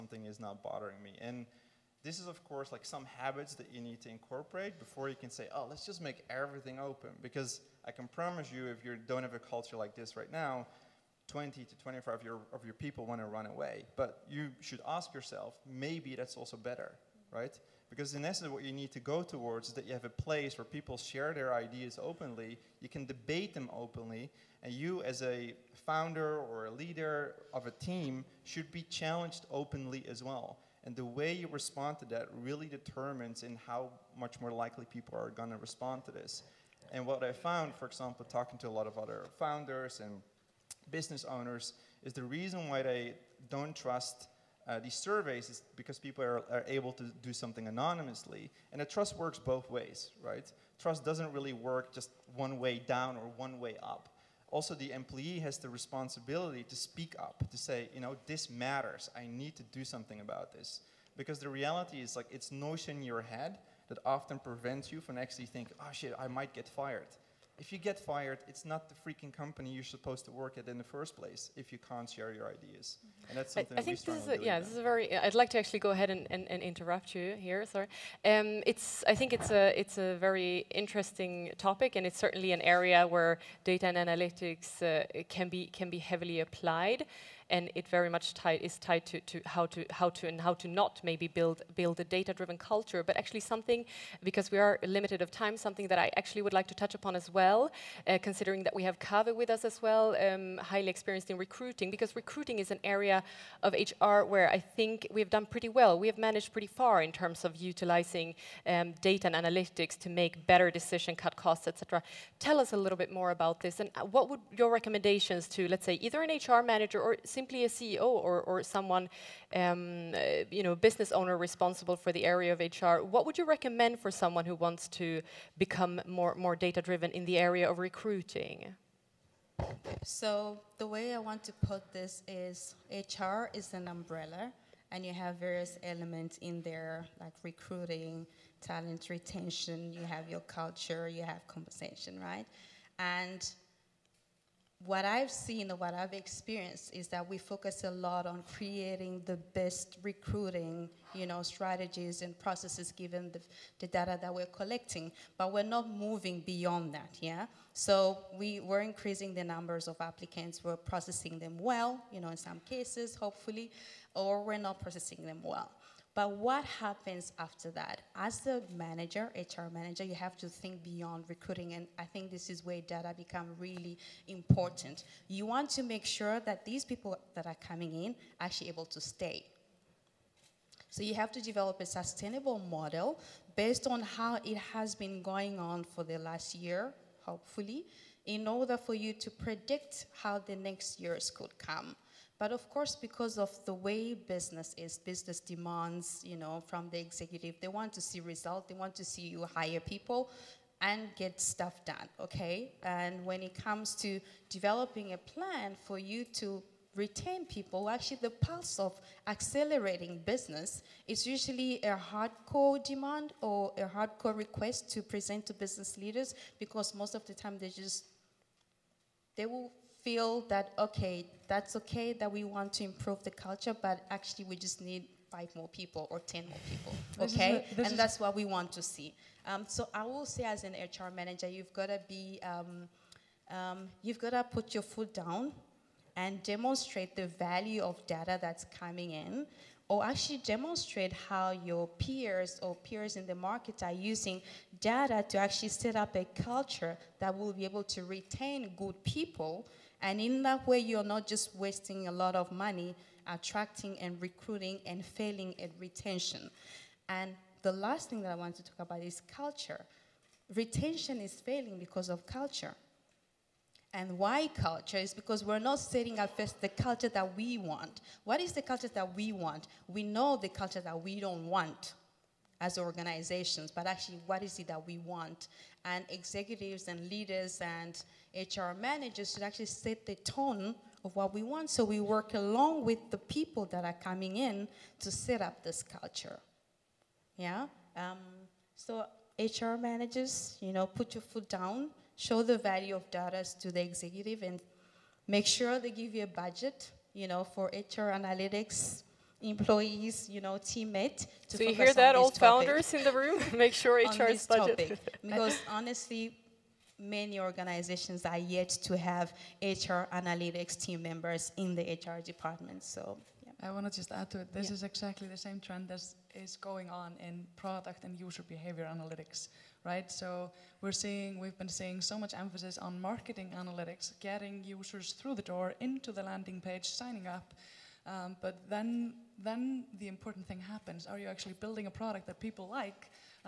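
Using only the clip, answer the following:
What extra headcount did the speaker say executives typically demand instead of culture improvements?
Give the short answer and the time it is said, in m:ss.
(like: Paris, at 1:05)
5 or 10 more people, at 3:45.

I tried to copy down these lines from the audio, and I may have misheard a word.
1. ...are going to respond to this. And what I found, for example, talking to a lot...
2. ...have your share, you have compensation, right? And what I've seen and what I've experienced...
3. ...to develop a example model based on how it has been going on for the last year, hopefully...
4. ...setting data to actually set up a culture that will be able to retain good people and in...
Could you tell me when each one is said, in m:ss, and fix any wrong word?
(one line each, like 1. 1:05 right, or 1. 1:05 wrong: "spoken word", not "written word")
1. 0:35 right
2. 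2:20 wrong: "culture", not "share"
3. 3:01 wrong: "sustainable", not "example"
4. 4:04 wrong: "using", not "setting".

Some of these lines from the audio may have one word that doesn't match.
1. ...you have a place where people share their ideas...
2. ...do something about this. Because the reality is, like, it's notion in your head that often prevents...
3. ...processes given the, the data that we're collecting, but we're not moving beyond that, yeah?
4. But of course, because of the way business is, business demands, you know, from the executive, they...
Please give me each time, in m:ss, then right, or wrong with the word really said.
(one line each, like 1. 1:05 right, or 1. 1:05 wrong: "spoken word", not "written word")
1. 0:19 right
2. 0:59 right
3. 2:32 right
4. 3:12 right.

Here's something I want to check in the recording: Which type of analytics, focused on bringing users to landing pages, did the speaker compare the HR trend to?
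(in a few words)
Marketing analytics.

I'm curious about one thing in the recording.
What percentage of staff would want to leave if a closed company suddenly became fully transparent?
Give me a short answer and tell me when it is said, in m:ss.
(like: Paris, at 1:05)
20 to 25, at 0:11.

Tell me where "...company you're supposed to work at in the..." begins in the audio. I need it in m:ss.
1:09.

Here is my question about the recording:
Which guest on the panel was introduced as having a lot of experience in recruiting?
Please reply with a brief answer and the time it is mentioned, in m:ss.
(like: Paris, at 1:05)
Kave, at 1:38.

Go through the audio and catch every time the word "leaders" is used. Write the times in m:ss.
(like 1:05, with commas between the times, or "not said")
0:26, 3:35, 4:37.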